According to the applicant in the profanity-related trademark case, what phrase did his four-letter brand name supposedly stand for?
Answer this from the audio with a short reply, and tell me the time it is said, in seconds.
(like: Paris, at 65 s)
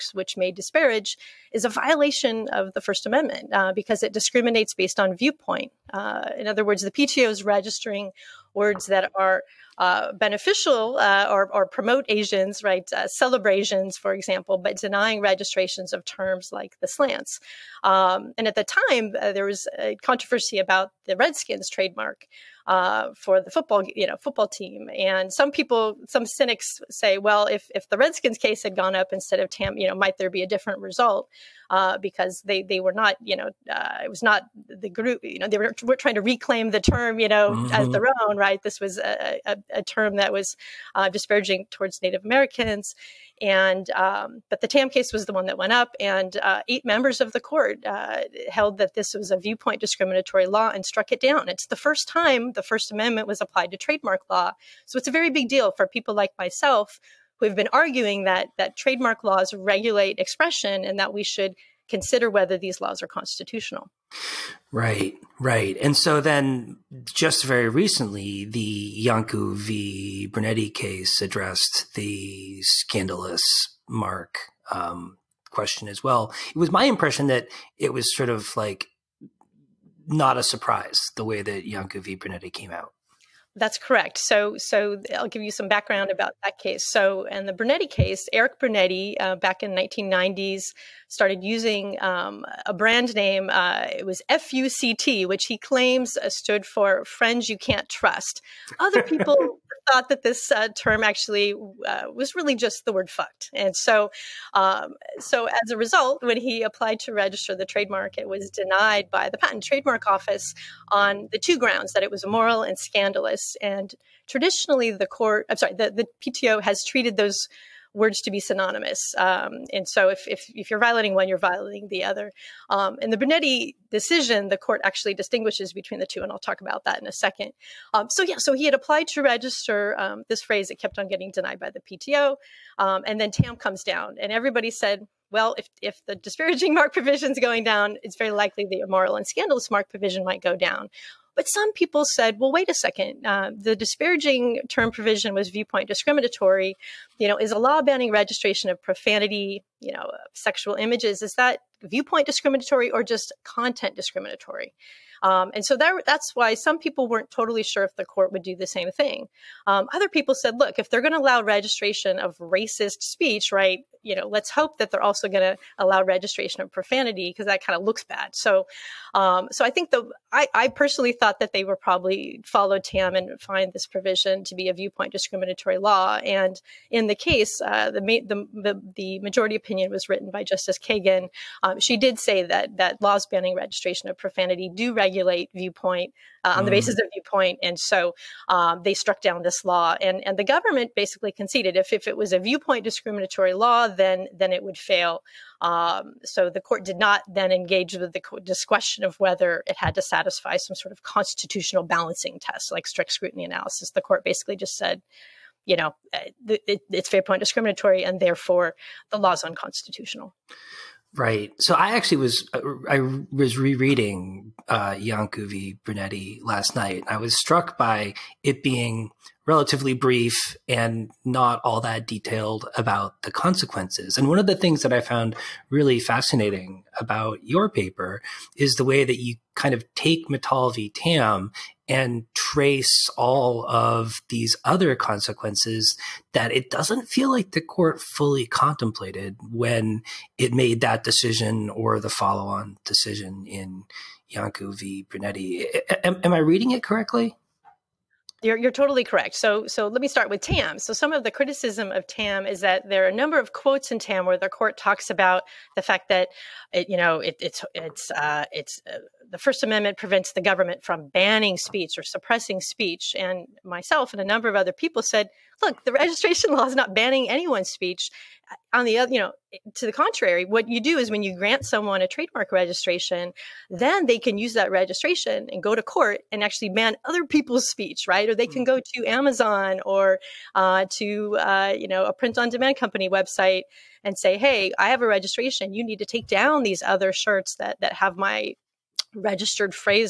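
Friends You Can't Trust, at 97 s.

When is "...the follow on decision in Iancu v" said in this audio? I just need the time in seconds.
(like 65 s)
241 s.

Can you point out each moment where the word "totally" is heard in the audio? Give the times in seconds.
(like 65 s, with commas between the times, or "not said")
157 s, 248 s.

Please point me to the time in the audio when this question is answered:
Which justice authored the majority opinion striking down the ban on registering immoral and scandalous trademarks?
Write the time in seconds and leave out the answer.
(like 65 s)
180 s.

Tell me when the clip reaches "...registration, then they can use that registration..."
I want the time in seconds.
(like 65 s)
272 s.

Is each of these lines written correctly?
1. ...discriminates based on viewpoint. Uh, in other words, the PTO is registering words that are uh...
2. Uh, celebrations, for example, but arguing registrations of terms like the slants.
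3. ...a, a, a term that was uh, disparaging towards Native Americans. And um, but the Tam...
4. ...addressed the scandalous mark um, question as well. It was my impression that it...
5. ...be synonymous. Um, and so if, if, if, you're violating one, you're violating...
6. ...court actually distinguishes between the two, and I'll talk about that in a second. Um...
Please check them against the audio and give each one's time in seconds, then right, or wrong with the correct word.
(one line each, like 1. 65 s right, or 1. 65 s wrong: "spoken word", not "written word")
1. 4 s right
2. 12 s wrong: "denying", not "arguing"
3. 38 s right
4. 71 s right
5. 118 s right
6. 124 s right.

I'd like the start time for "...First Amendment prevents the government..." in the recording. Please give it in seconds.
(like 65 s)
259 s.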